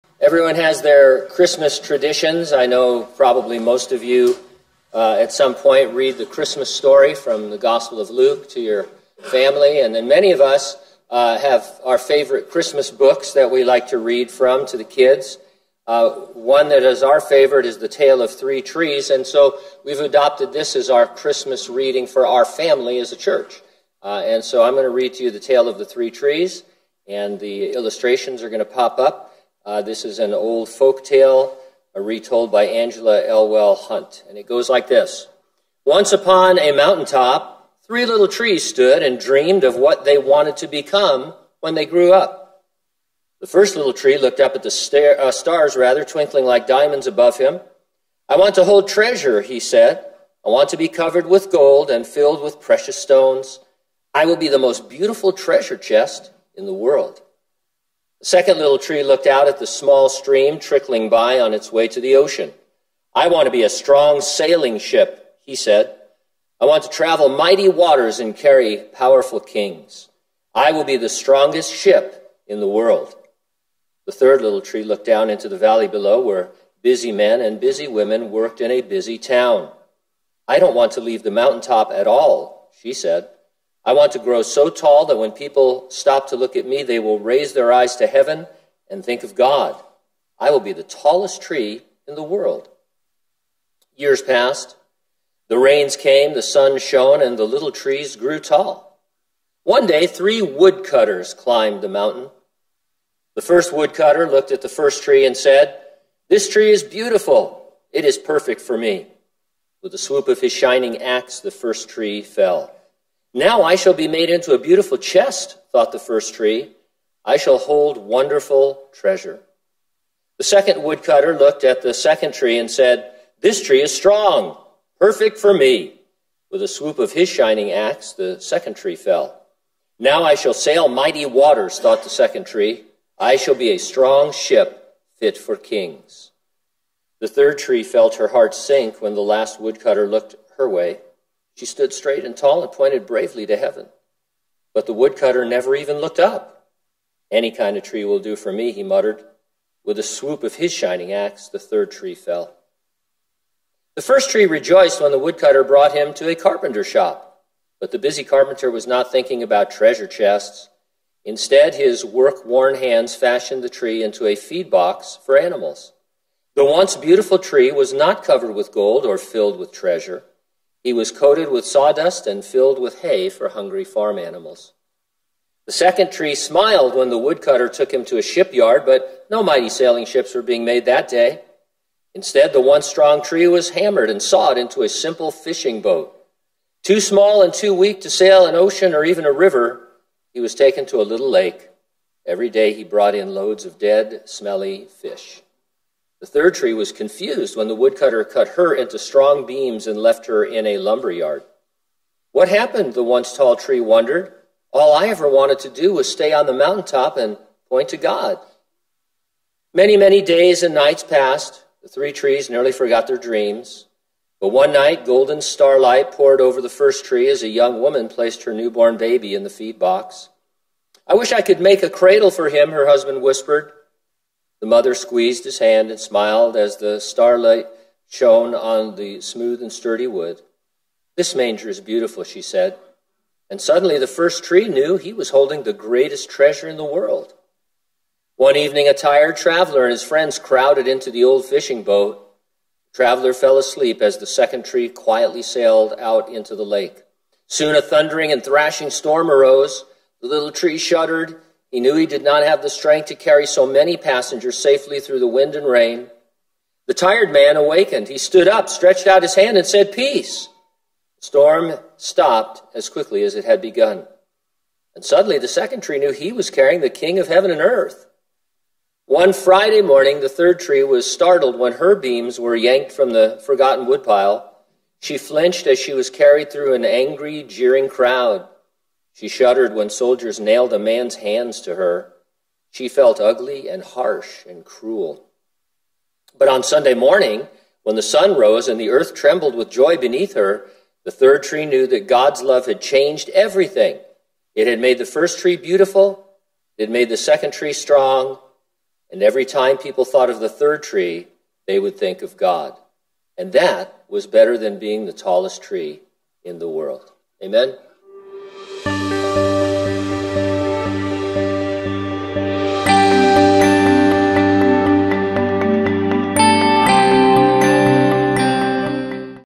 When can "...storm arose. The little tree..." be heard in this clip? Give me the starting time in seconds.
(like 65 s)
248 s.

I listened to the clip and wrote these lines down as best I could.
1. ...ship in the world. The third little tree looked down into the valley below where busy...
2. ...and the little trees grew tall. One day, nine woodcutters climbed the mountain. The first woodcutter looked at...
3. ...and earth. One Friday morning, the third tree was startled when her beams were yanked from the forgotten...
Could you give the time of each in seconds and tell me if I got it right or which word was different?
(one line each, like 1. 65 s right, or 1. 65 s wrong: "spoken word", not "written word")
1. 71 s right
2. 97 s wrong: "three", not "nine"
3. 267 s right.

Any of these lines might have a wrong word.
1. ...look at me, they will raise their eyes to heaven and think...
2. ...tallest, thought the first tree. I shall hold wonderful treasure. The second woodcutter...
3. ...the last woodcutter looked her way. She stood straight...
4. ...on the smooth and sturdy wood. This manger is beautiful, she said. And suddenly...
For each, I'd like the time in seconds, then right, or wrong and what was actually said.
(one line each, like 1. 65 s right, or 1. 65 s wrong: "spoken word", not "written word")
1. 86 s right
2. 114 s wrong: "chest", not "tallest"
3. 139 s right
4. 228 s right.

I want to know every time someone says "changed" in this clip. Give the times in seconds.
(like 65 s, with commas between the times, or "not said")
292 s.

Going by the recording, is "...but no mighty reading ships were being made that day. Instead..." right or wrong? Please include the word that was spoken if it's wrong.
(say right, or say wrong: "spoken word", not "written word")
wrong: "sailing", not "reading".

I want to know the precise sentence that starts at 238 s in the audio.
One evening, a tired traveler and his friends crowded into the old fishing boat.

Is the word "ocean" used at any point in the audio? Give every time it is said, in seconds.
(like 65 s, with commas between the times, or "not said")
62 s, 188 s.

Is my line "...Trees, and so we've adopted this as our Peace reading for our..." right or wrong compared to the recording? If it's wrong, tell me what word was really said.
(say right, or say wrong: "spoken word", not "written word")
wrong: "Christmas", not "Peace".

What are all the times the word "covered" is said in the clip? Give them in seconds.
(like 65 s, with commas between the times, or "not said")
50 s, 168 s.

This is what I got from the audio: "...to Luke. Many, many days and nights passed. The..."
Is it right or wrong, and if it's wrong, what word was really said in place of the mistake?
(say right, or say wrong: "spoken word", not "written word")
wrong: "God", not "Luke".